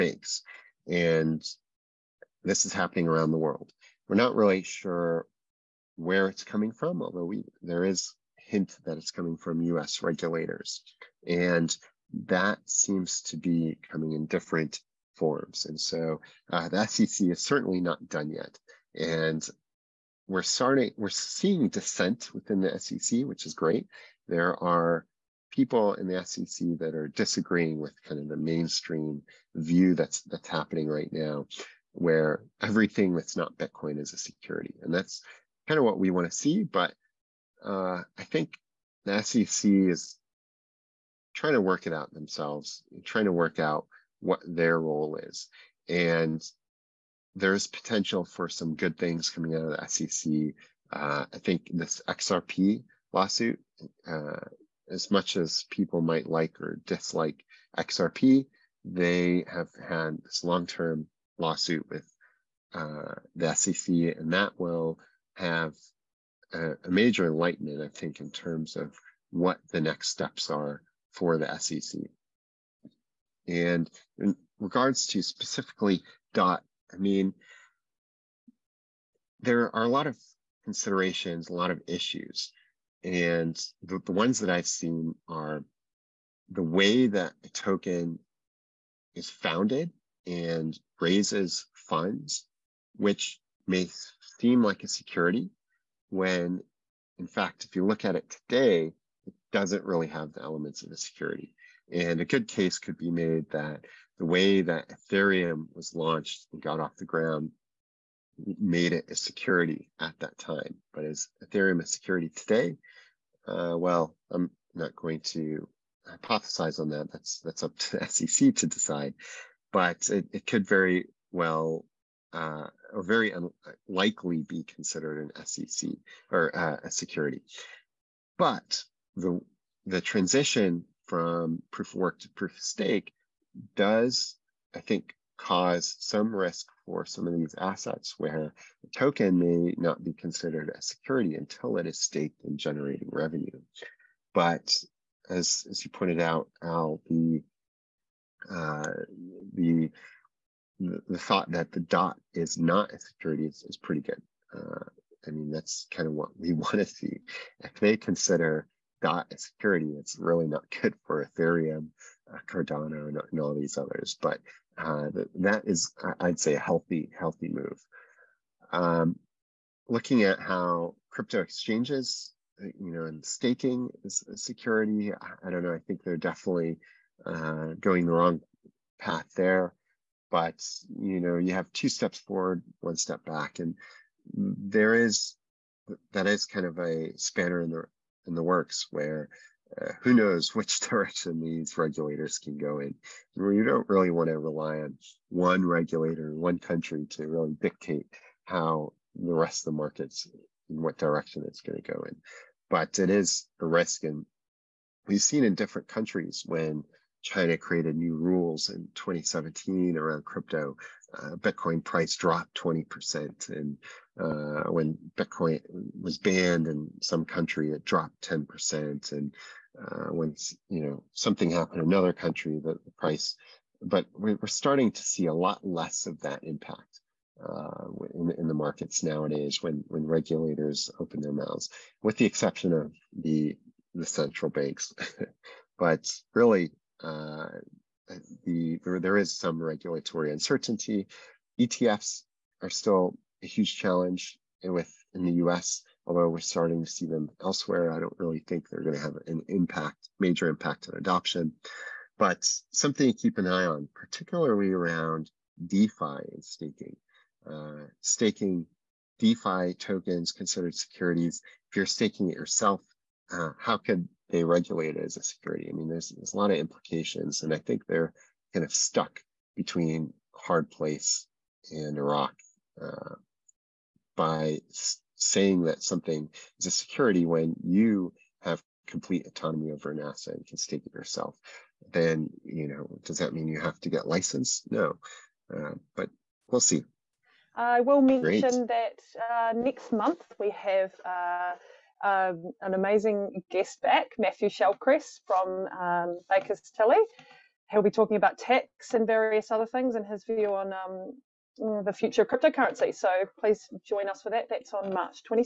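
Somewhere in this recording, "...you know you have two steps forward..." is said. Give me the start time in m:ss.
3:00.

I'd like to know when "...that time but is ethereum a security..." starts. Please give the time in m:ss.
1:50.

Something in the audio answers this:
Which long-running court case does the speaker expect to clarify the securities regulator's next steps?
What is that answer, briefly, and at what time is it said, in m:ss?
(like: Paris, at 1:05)
XRP lawsuit, at 0:52.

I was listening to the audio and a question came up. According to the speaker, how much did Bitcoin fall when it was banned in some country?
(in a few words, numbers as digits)
10%.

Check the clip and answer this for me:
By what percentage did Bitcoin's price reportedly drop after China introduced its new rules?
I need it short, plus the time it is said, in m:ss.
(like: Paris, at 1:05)
20%, at 3:32.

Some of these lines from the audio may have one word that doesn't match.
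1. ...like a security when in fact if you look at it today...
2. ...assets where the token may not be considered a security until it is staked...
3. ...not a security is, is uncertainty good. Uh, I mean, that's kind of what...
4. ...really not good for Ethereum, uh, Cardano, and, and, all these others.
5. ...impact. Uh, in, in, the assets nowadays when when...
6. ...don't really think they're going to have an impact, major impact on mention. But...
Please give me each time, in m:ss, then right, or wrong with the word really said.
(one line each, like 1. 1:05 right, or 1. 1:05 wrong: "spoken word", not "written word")
1. 1:34 right
2. 2:17 right
3. 2:32 wrong: "pretty", not "uncertainty"
4. 2:40 right
5. 3:46 wrong: "markets", not "assets"
6. 4:08 wrong: "adoption", not "mention".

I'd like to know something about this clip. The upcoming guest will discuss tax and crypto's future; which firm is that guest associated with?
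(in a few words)
Baker Tilly.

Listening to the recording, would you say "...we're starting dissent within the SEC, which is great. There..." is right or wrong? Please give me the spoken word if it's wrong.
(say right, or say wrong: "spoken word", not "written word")
wrong: "seeing", not "starting".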